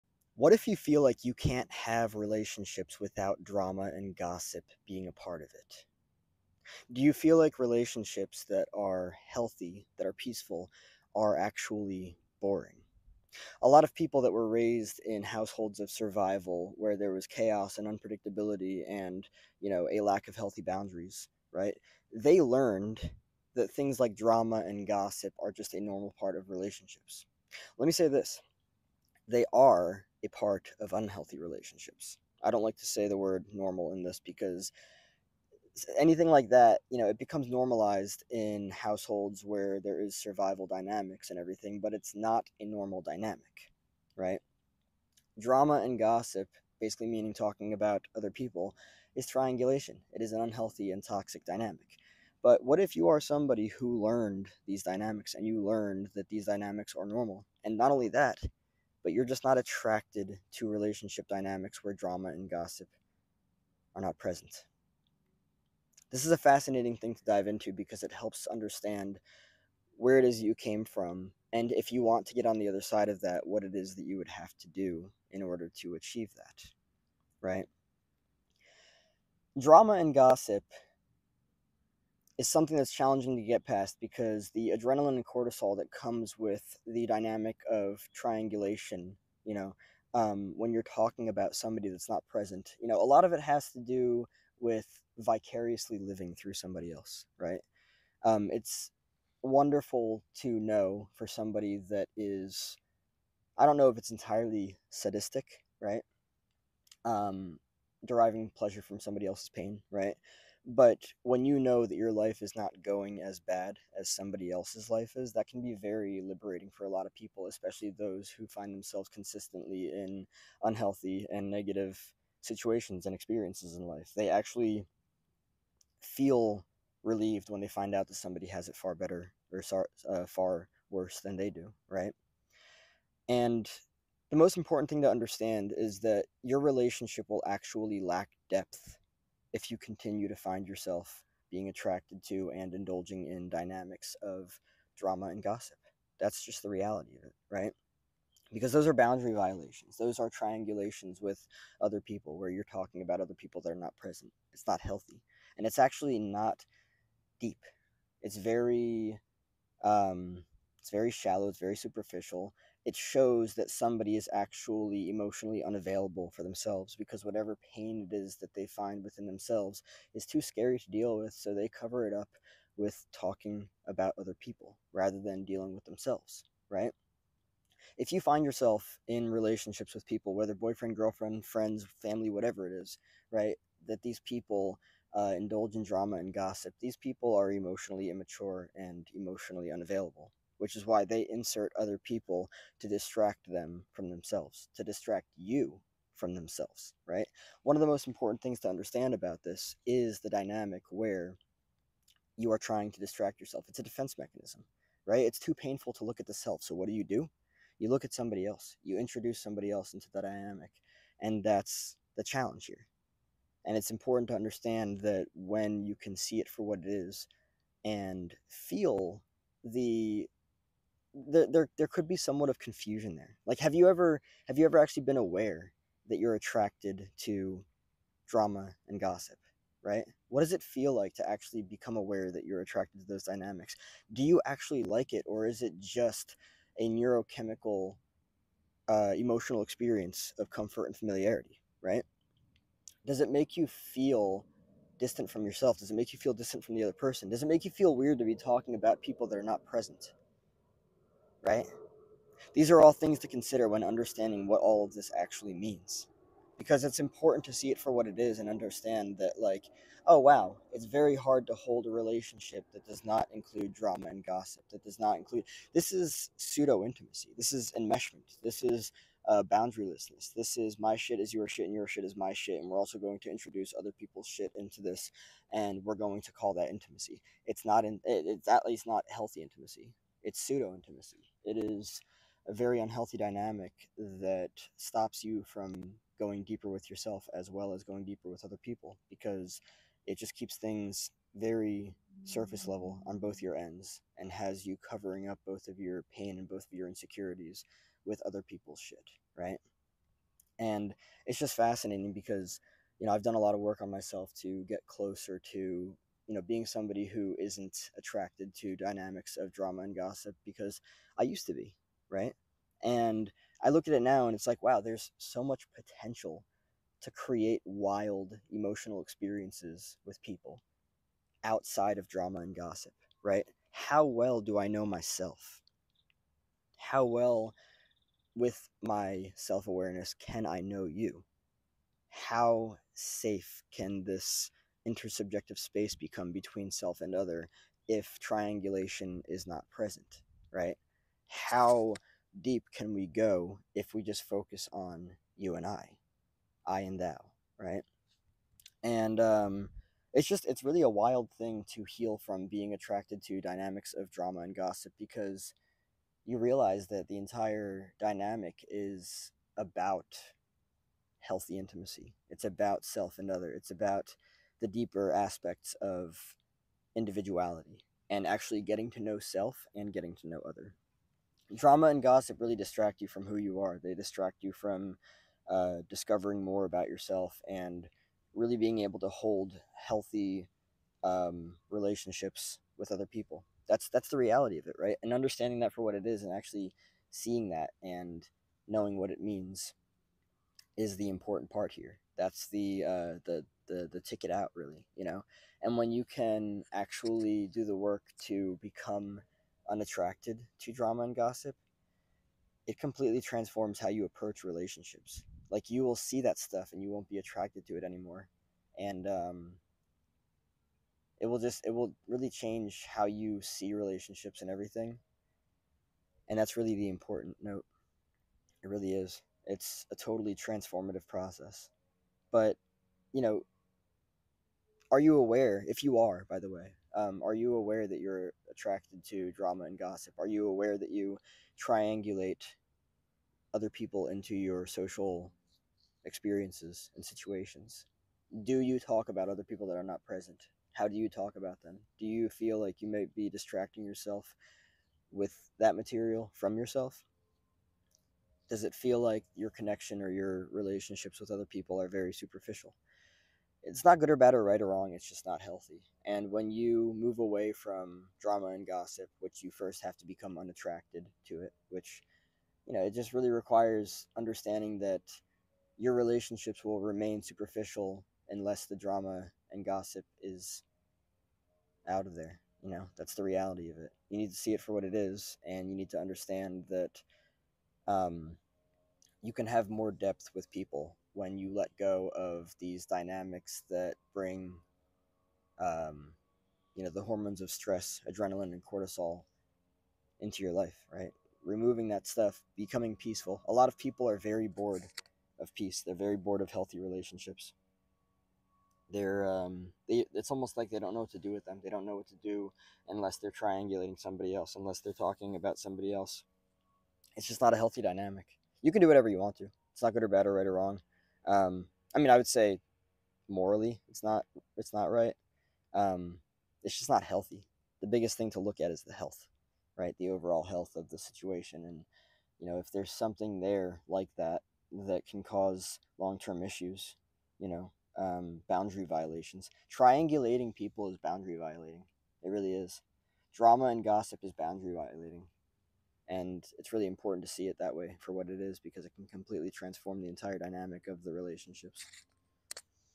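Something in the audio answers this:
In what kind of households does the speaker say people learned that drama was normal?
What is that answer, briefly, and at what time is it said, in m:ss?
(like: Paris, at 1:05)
households of survival, at 0:15.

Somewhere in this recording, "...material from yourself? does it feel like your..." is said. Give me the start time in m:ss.
7:25.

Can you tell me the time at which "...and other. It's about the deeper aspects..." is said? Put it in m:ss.
6:03.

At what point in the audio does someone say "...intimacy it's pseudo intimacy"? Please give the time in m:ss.
4:39.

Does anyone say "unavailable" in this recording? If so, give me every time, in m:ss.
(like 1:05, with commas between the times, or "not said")
2:45, 3:09.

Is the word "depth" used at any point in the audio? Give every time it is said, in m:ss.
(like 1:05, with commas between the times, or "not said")
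2:18, 7:59.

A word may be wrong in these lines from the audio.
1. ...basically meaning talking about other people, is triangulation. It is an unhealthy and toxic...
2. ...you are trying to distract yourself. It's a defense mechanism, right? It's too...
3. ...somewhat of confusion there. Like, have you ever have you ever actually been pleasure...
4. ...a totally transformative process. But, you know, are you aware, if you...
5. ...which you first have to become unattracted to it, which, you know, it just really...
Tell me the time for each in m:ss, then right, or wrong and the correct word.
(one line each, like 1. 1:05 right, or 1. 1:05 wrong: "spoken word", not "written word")
1. 0:46 right
2. 3:22 right
3. 3:42 wrong: "aware", not "pleasure"
4. 6:59 right
5. 7:39 right.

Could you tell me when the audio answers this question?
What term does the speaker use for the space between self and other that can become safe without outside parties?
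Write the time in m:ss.
5:34.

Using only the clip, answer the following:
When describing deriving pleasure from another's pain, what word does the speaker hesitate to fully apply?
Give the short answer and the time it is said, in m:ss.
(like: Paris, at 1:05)
sadistic, at 1:44.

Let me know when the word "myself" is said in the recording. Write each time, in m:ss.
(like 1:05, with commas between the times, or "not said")
5:03, 5:24.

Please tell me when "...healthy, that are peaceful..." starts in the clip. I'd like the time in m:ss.
0:09.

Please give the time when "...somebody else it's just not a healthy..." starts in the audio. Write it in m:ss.
8:25.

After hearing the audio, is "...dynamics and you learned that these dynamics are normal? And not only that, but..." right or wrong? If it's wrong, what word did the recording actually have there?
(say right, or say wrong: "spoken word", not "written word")
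right.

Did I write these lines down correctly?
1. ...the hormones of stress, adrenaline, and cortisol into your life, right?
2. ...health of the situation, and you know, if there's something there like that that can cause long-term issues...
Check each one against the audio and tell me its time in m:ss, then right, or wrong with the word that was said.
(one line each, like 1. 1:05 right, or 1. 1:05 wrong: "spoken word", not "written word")
1. 8:06 right
2. 8:40 right.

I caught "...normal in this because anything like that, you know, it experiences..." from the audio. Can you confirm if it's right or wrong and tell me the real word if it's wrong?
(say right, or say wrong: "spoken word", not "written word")
wrong: "becomes", not "experiences".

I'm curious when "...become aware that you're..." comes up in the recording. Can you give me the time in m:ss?
3:51.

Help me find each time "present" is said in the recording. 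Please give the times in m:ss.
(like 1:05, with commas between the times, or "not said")
1:04, 1:32, 2:33, 4:09, 5:39, 7:20.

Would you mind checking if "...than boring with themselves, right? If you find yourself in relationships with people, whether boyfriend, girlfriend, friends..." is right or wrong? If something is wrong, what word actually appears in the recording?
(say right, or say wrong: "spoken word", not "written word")
wrong: "dealing", not "boring".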